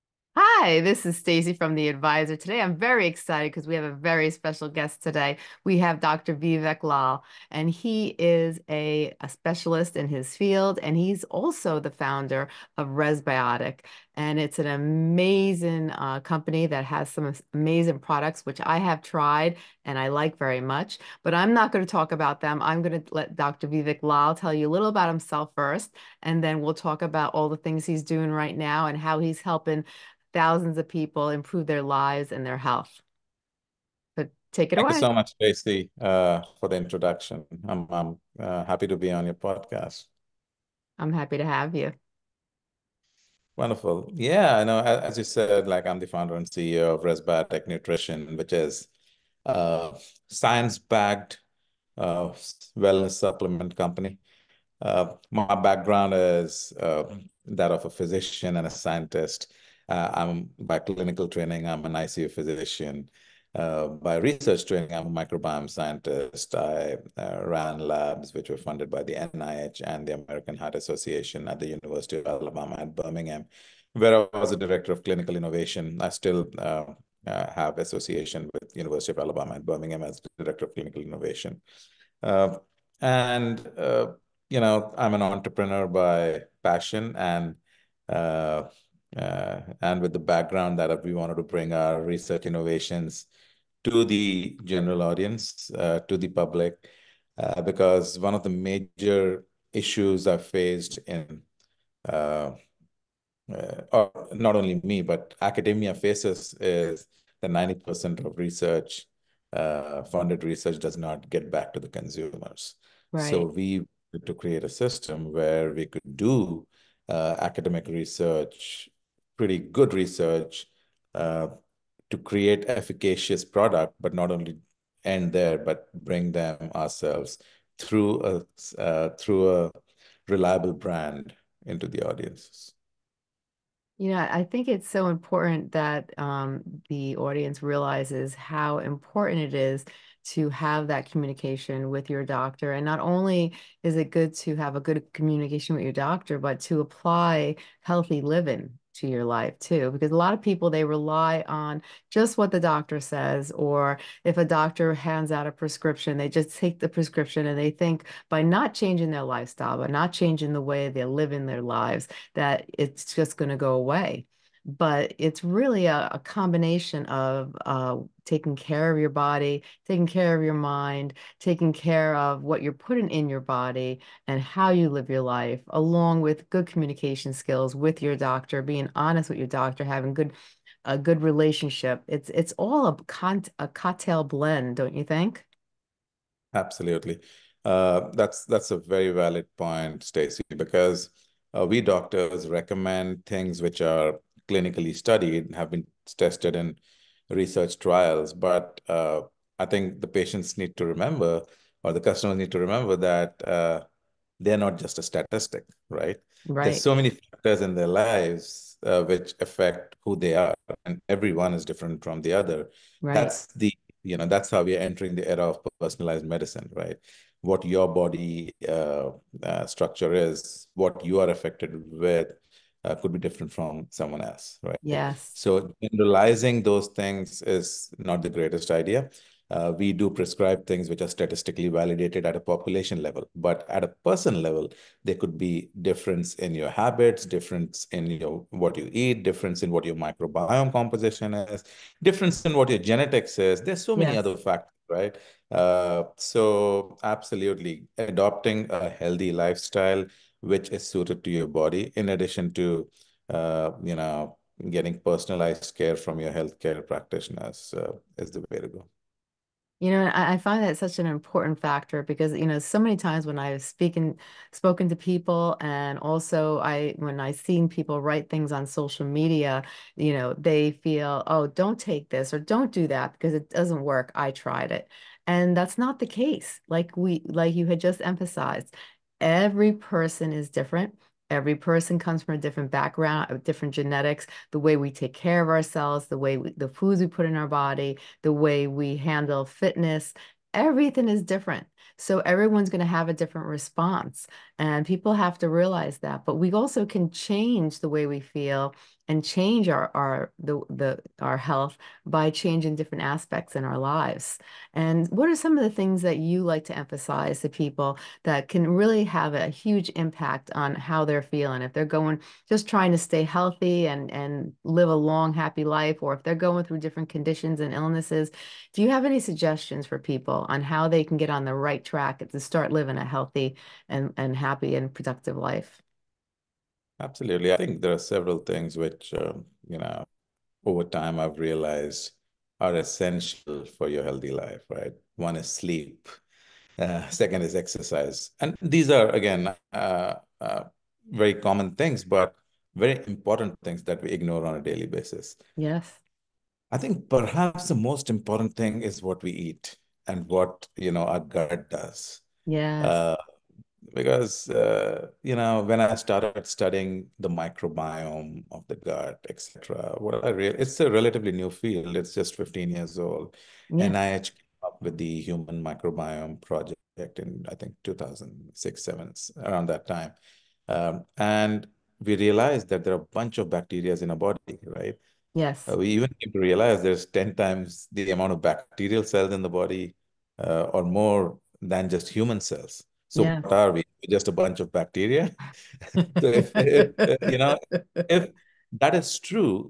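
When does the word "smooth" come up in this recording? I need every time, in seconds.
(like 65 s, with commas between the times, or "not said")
not said.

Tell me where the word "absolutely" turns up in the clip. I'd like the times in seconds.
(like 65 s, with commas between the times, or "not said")
186 s, 247 s, 326 s.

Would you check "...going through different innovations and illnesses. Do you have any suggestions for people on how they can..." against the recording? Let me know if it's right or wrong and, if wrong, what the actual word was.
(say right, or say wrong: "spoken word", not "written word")
wrong: "conditions", not "innovations".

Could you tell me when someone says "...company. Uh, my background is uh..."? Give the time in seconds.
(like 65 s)
53 s.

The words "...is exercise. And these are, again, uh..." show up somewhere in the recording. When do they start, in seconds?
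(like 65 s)
337 s.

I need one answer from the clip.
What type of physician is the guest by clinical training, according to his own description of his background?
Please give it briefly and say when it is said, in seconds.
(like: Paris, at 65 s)
ICU physician, at 61 s.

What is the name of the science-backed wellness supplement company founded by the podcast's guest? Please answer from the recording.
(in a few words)
Resbiotic Nutrition.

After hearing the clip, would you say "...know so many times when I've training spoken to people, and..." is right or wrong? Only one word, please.
wrong.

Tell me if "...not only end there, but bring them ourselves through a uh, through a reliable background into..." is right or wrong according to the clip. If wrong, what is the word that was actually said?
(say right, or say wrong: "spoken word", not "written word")
wrong: "brand", not "background".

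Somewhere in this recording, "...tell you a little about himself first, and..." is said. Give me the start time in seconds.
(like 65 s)
24 s.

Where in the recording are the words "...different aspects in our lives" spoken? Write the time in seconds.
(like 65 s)
302 s.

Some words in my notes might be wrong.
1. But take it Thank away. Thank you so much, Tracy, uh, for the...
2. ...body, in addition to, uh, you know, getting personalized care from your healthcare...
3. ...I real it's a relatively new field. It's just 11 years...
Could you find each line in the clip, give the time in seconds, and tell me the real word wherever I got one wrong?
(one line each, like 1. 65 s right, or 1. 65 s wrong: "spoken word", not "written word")
1. 34 s right
2. 251 s right
3. 360 s wrong: "15", not "11".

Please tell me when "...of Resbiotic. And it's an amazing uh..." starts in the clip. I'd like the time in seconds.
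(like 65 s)
12 s.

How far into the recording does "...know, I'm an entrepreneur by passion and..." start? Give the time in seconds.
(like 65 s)
84 s.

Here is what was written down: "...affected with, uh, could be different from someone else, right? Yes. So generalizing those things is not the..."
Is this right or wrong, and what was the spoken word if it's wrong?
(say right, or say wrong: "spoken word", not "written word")
right.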